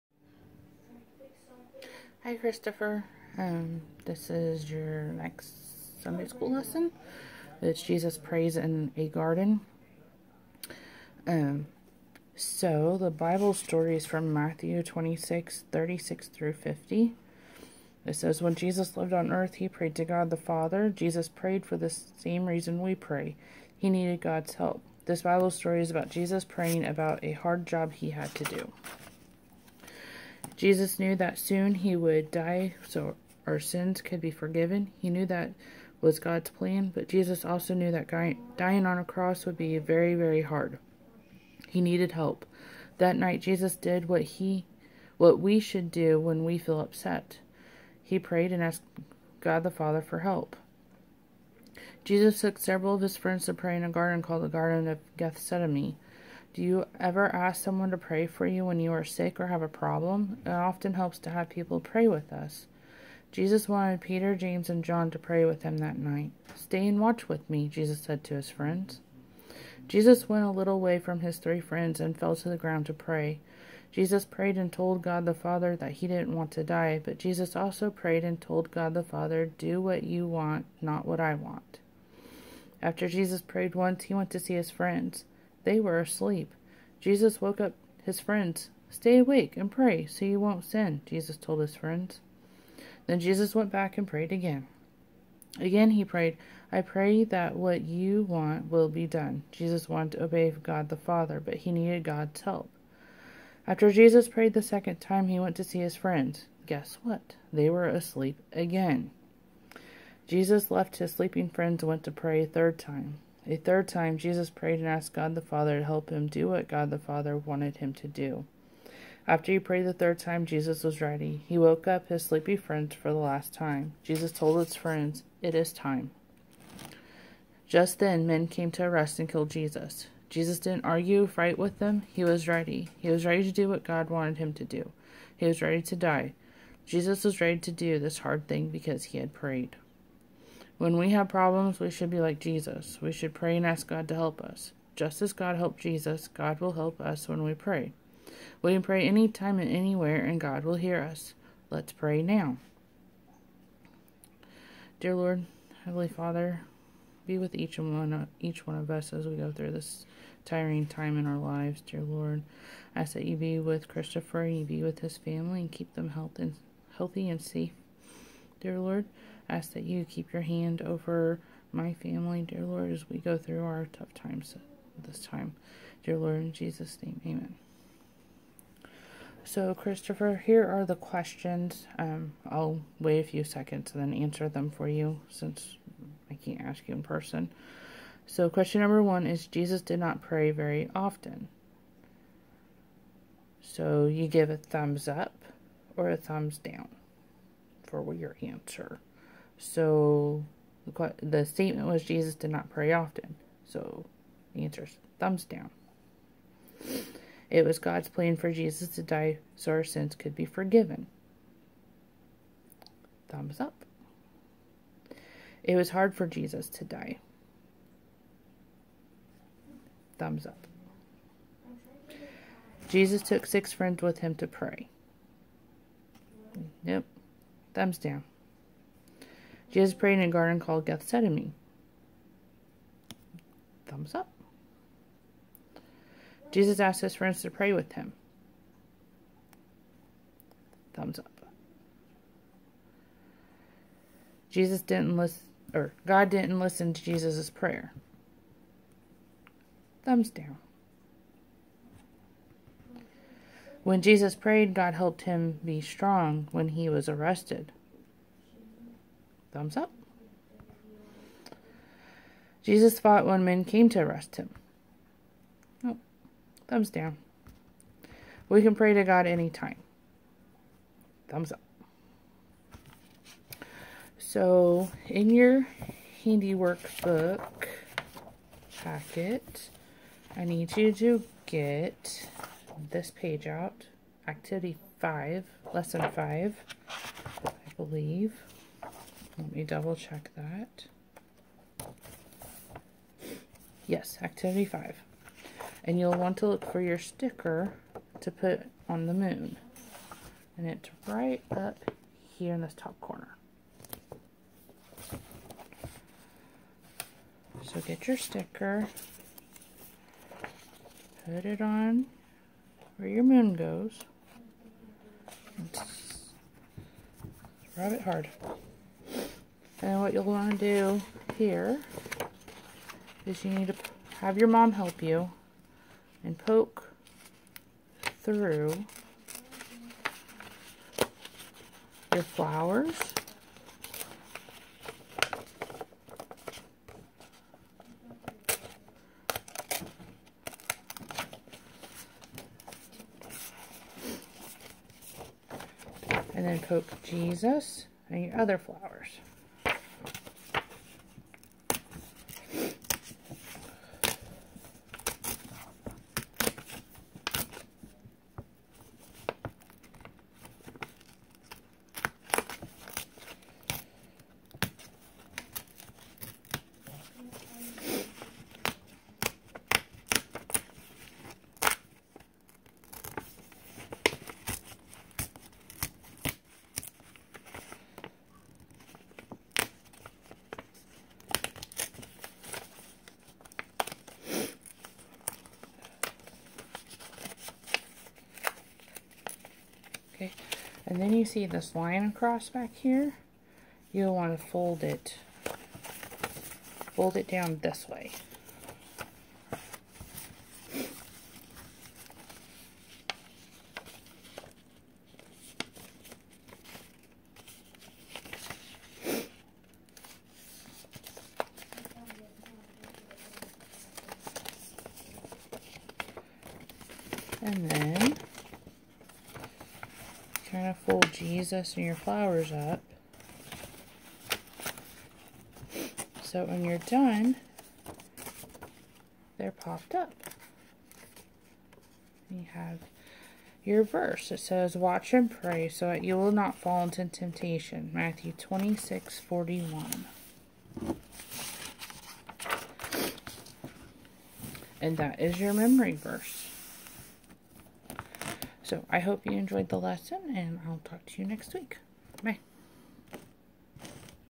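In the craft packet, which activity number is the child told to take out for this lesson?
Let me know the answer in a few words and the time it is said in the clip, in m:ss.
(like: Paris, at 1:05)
5, at 4:54.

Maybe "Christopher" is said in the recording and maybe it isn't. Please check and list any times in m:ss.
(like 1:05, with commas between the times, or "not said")
0:02, 2:43, 2:59.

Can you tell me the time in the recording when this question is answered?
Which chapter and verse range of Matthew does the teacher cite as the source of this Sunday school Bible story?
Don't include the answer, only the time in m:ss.
0:14.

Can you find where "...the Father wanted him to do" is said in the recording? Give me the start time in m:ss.
1:56.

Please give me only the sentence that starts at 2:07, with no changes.
Just then, men came to arrest and kill Jesus.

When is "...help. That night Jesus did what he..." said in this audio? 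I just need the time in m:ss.
0:42.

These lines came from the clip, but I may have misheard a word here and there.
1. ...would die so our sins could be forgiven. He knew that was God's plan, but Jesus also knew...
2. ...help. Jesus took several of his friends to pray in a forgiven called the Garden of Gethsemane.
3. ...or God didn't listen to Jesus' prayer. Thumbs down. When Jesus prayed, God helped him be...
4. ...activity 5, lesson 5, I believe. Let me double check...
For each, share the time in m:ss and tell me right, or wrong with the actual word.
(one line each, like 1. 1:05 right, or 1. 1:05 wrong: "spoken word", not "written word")
1. 0:31 right
2. 0:50 wrong: "garden", not "forgiven"
3. 4:05 right
4. 4:44 right.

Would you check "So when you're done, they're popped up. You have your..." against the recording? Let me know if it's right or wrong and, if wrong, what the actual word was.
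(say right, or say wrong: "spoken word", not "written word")
right.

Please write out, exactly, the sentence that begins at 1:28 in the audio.
Stay awake and pray so you won't sin, Jesus told his friends.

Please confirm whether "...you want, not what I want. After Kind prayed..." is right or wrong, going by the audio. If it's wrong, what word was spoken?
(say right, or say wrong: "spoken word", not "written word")
wrong: "Jesus", not "Kind".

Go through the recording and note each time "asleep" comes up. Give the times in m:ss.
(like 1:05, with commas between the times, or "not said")
1:25, 1:47.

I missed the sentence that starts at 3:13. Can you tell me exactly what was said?
So, you give a thumbs up or a thumbs down for your answer.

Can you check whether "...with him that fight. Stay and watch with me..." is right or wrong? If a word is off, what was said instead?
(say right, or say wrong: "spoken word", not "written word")
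wrong: "night", not "fight".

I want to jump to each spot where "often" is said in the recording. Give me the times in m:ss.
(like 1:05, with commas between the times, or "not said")
1:00, 3:10, 3:22.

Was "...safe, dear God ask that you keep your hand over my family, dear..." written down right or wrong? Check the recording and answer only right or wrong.
wrong.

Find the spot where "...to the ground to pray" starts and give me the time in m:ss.
1:12.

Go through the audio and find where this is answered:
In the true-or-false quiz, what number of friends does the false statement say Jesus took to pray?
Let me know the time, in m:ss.
3:43.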